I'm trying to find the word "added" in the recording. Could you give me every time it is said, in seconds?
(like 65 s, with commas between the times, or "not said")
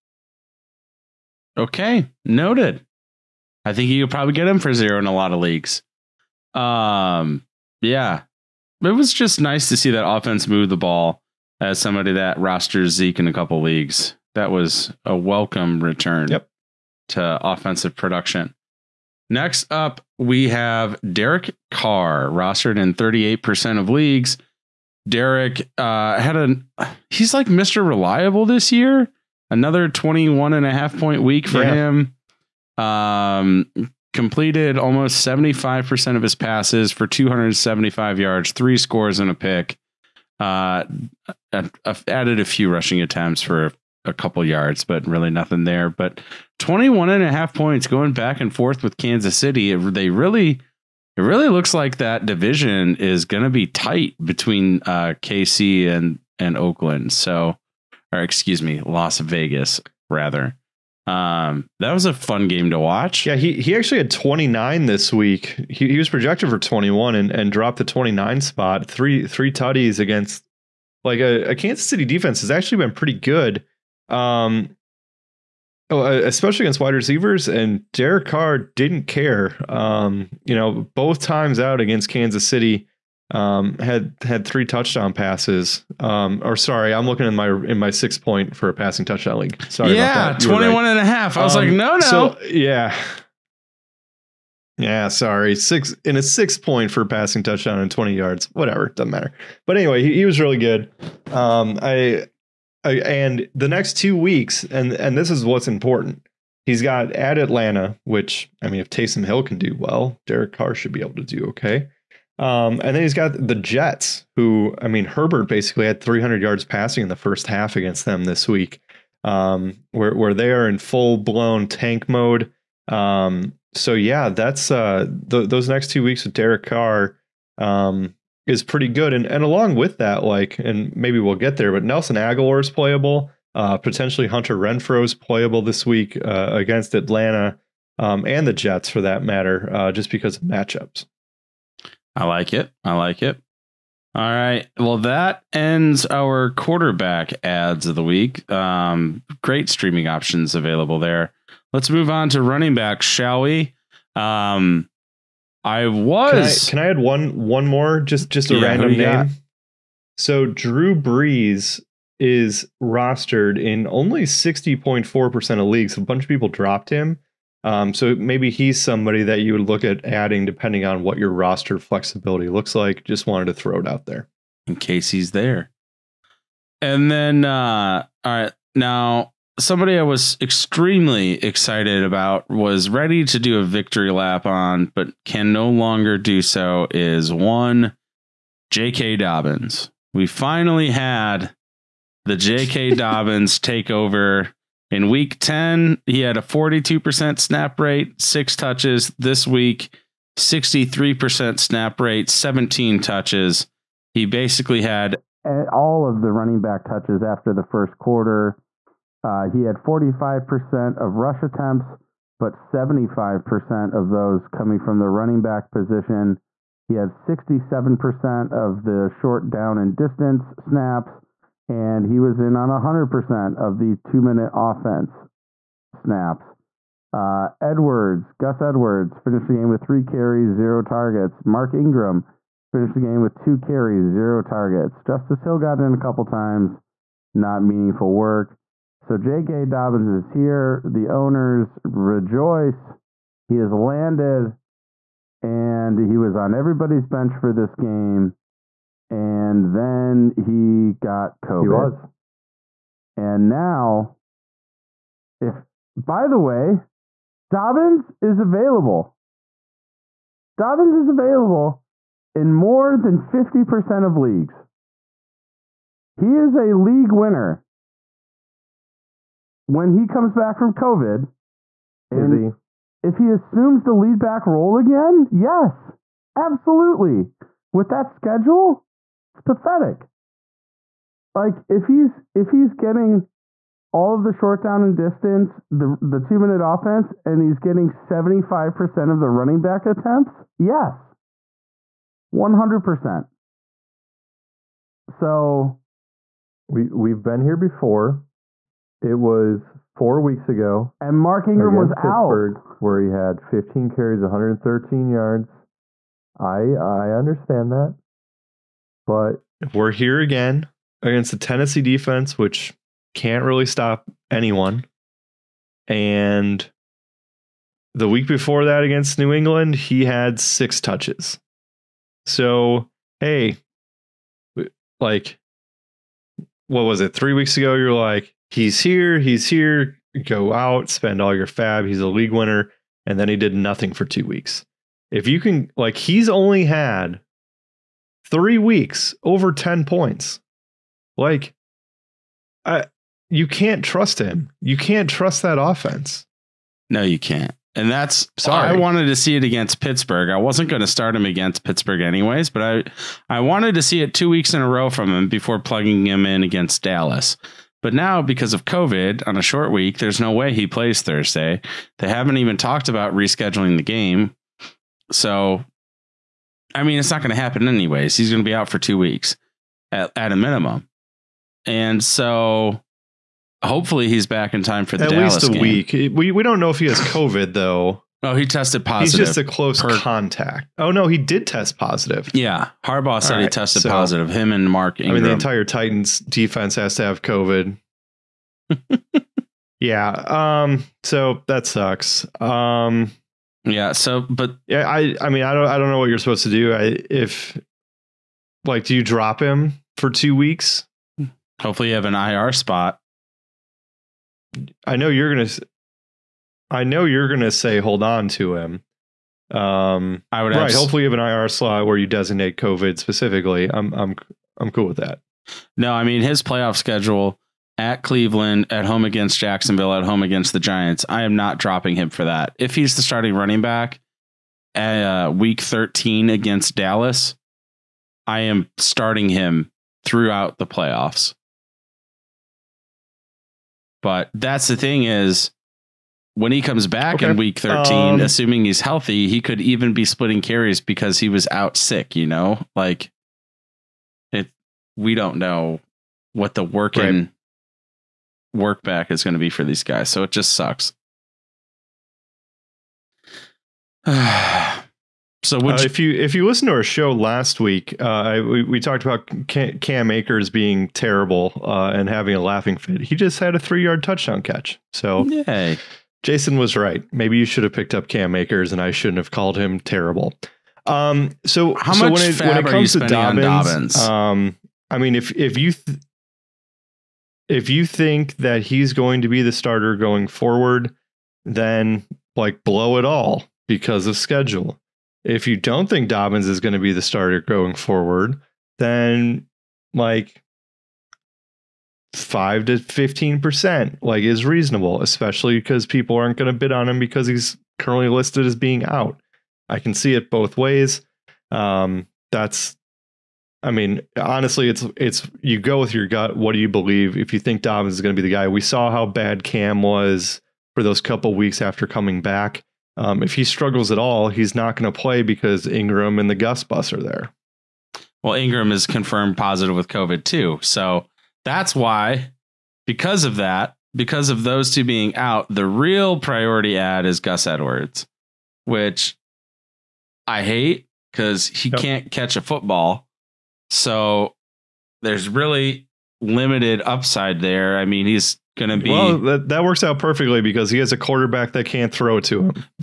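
42 s.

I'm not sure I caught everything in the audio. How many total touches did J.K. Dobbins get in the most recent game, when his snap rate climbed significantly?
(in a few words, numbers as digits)
17.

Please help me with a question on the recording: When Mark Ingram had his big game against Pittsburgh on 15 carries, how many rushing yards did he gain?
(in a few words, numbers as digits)
113 yards.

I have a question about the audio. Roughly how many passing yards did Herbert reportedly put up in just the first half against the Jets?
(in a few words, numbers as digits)
300 yards.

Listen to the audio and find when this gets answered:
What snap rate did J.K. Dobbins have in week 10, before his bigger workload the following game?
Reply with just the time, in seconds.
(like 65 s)
196 s.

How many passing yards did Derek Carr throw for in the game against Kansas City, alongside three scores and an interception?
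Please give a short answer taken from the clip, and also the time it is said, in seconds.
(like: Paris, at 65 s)
275 yards, at 37 s.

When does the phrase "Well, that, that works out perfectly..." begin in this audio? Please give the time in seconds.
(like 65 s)
538 s.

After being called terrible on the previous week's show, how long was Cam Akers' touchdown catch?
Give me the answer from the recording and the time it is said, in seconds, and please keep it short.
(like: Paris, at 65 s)
3 yards, at 463 s.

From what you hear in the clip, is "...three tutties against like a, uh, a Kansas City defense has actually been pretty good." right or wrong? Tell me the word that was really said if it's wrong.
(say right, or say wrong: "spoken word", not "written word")
right.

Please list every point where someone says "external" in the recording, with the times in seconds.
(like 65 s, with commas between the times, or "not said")
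not said.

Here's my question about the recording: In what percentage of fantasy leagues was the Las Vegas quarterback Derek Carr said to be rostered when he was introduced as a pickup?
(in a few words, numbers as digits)
38%.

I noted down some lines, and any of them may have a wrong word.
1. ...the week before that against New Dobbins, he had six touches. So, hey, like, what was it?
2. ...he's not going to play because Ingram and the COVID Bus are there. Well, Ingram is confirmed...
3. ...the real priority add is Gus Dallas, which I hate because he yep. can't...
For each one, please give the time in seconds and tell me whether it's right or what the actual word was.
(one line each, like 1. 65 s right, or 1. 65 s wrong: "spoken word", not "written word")
1. 317 s wrong: "England", not "Dobbins"
2. 514 s wrong: "Gus", not "COVID"
3. 525 s wrong: "Edwards", not "Dallas".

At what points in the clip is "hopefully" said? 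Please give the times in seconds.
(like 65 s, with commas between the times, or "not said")
373 s, 401 s, 410 s.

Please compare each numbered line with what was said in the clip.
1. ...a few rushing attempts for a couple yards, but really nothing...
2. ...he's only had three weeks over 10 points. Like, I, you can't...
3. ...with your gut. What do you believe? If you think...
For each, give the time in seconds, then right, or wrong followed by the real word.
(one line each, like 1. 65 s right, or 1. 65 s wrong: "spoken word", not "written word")
1. 42 s right
2. 335 s right
3. 505 s right.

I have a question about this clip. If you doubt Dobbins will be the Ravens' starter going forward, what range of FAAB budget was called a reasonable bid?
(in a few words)
5 to 15%.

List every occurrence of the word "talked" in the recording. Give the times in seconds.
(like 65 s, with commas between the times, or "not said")
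362 s, 458 s.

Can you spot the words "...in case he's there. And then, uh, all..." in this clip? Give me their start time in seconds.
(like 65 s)
174 s.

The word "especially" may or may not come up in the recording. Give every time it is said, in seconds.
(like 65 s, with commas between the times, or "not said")
76 s, 495 s.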